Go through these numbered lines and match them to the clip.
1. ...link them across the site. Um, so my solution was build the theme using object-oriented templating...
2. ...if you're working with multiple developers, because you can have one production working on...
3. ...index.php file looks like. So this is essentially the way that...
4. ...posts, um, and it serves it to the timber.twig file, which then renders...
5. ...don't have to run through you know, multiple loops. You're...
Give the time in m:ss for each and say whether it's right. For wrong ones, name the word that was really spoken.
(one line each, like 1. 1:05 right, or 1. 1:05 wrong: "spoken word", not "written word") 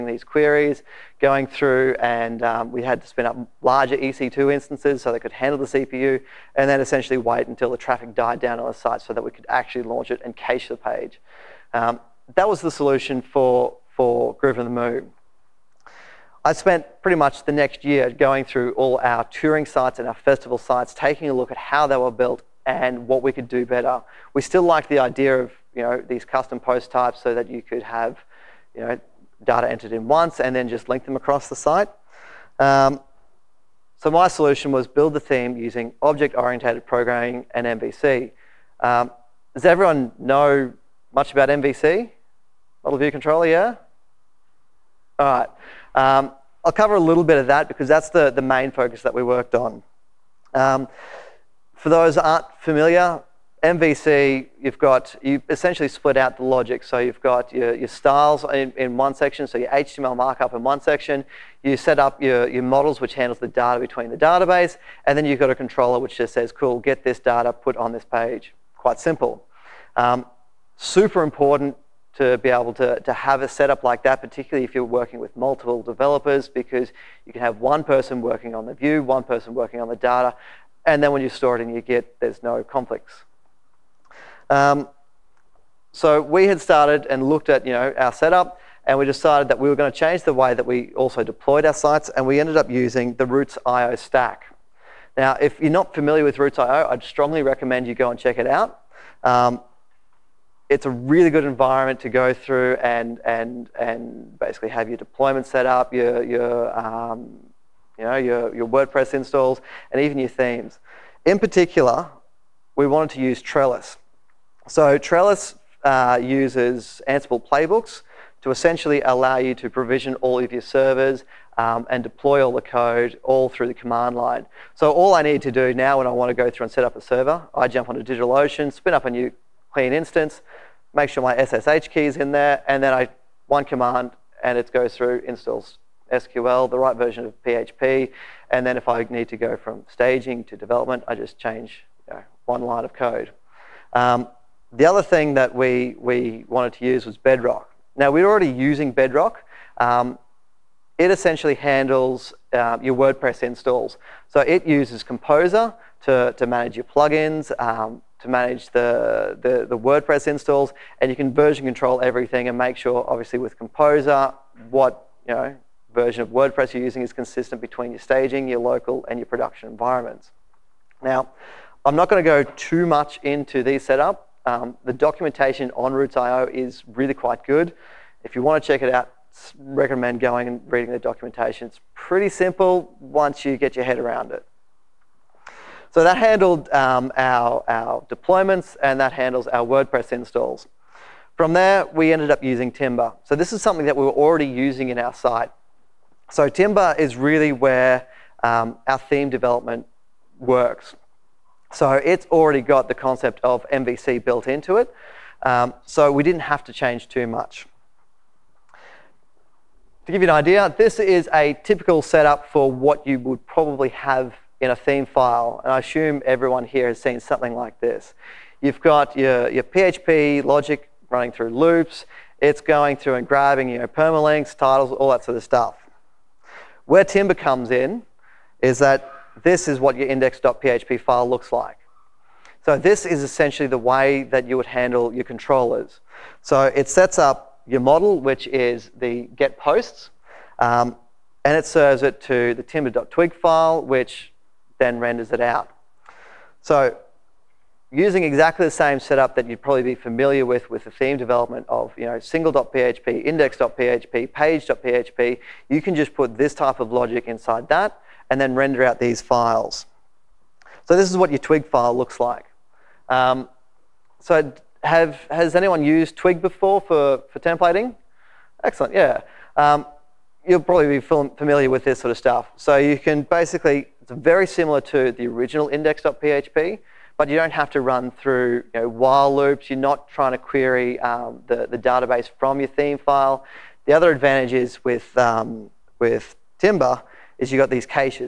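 1. 0:30 wrong: "programming", not "templating"
2. 1:14 wrong: "person", not "production"
3. 3:50 right
4. 3:59 right
5. 4:37 wrong: "while", not "multiple".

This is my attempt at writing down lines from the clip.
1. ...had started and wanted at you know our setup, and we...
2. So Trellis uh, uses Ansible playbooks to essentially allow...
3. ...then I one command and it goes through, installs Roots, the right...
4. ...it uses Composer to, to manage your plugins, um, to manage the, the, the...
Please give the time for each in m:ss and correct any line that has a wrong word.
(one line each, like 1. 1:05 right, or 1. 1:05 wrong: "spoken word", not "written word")
1. 1:26 wrong: "looked", not "wanted"
2. 1:54 right
3. 2:12 wrong: "SQL", not "Roots"
4. 2:34 right.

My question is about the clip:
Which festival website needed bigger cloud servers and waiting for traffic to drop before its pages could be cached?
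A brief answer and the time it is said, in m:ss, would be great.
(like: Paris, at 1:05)
Groovin the Moo, at 0:14.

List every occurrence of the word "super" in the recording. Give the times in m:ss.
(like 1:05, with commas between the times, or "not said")
1:10.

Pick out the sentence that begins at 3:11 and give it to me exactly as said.
From there, we ended up using Timber.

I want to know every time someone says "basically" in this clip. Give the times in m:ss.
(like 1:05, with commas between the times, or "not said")
1:44, 4:33.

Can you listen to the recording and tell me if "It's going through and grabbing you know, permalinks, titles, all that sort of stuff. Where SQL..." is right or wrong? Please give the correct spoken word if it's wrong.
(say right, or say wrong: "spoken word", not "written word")
wrong: "Timber", not "SQL".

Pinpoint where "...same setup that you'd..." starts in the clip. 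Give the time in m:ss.
4:08.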